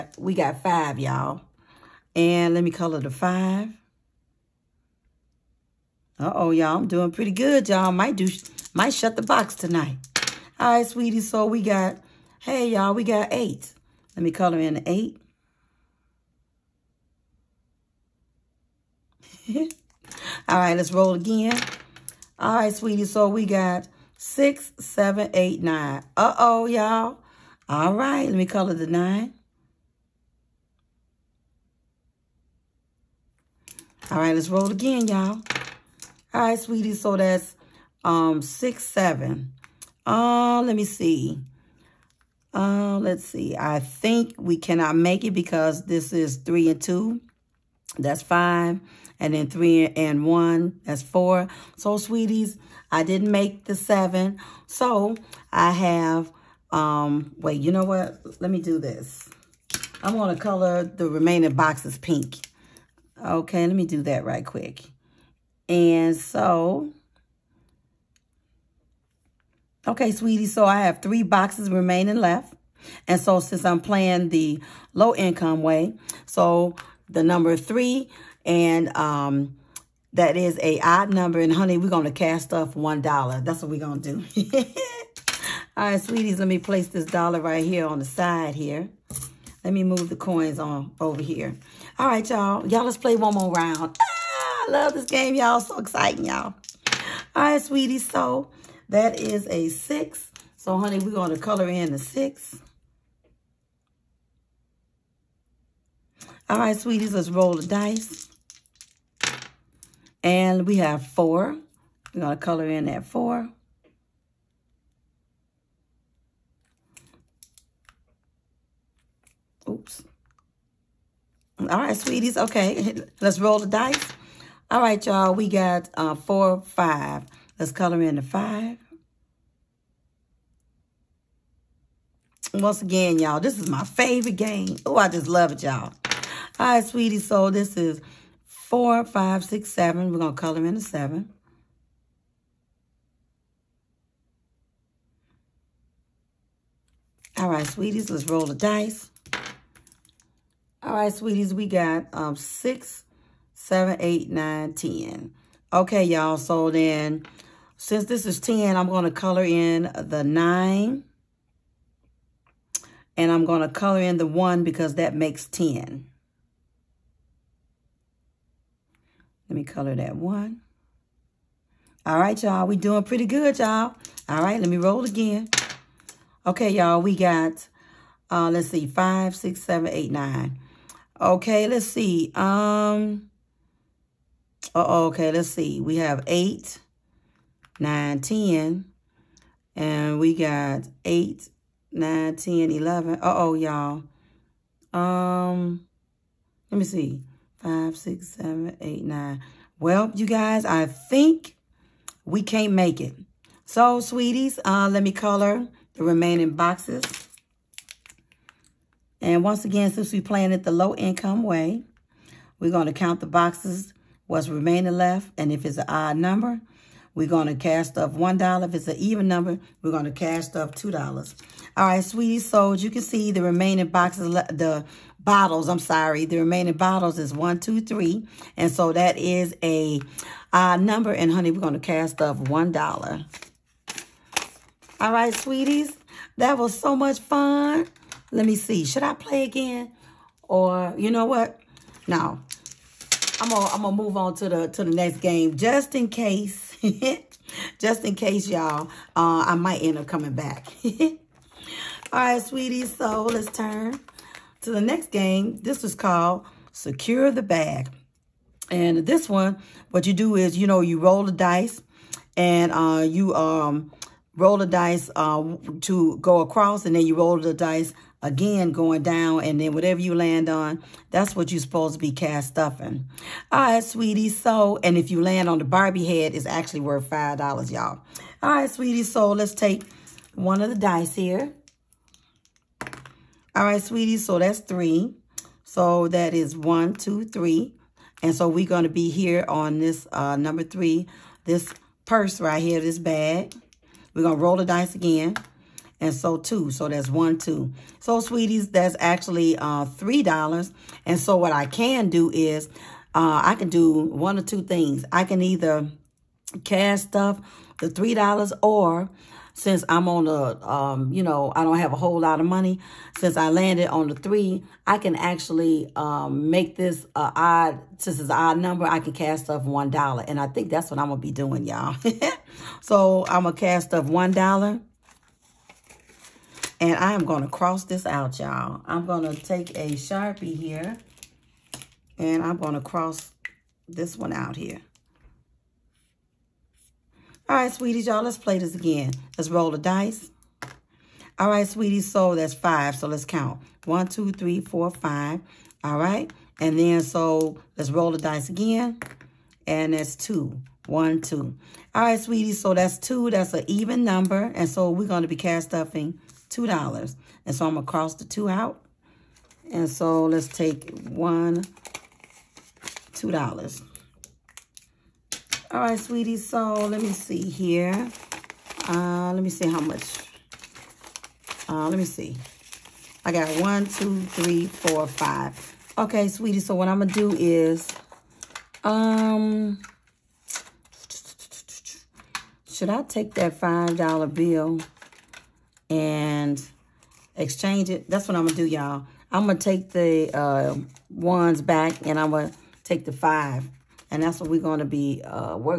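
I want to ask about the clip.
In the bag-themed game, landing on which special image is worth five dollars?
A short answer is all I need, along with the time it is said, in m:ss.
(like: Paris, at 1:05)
Barbie head, at 4:35.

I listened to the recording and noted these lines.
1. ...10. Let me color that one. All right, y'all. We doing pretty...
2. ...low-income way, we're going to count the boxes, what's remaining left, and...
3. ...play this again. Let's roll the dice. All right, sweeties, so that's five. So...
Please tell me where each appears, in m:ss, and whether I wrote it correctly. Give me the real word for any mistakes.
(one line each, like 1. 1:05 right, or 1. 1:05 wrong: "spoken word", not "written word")
1. 2:45 right
2. 3:30 right
3. 5:38 right.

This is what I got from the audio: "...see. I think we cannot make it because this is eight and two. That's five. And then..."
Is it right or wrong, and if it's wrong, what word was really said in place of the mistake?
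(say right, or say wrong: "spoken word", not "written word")
wrong: "three", not "eight".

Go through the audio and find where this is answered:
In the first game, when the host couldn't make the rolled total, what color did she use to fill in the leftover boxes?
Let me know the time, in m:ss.
1:01.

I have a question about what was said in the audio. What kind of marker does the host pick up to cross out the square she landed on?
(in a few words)
Sharpie.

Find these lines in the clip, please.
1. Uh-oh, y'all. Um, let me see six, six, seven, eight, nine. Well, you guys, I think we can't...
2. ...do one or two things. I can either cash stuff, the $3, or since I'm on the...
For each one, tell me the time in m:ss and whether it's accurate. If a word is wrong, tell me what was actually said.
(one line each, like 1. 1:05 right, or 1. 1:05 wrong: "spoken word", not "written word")
1. 3:13 wrong: "five", not "six"
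2. 5:03 right.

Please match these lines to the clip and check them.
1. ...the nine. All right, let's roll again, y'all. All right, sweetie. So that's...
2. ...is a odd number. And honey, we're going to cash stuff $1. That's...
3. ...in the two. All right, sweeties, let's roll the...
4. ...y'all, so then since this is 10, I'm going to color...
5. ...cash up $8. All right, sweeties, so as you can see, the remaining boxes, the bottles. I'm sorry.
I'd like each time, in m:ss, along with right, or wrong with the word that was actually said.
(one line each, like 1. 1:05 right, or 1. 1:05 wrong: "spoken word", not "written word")
1. 0:28 right
2. 1:20 right
3. 1:41 wrong: "six", not "two"
4. 2:36 right
5. 3:40 wrong: "2", not "8".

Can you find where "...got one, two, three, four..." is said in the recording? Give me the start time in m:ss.
6:13.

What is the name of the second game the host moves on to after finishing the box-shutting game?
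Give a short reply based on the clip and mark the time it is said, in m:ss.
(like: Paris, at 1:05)
Secure the Bag, at 4:16.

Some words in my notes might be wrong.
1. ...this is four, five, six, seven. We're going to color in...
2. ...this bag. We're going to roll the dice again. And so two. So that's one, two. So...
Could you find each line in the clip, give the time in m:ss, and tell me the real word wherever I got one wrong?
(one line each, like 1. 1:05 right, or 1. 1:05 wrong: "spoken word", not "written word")
1. 2:17 right
2. 4:52 right.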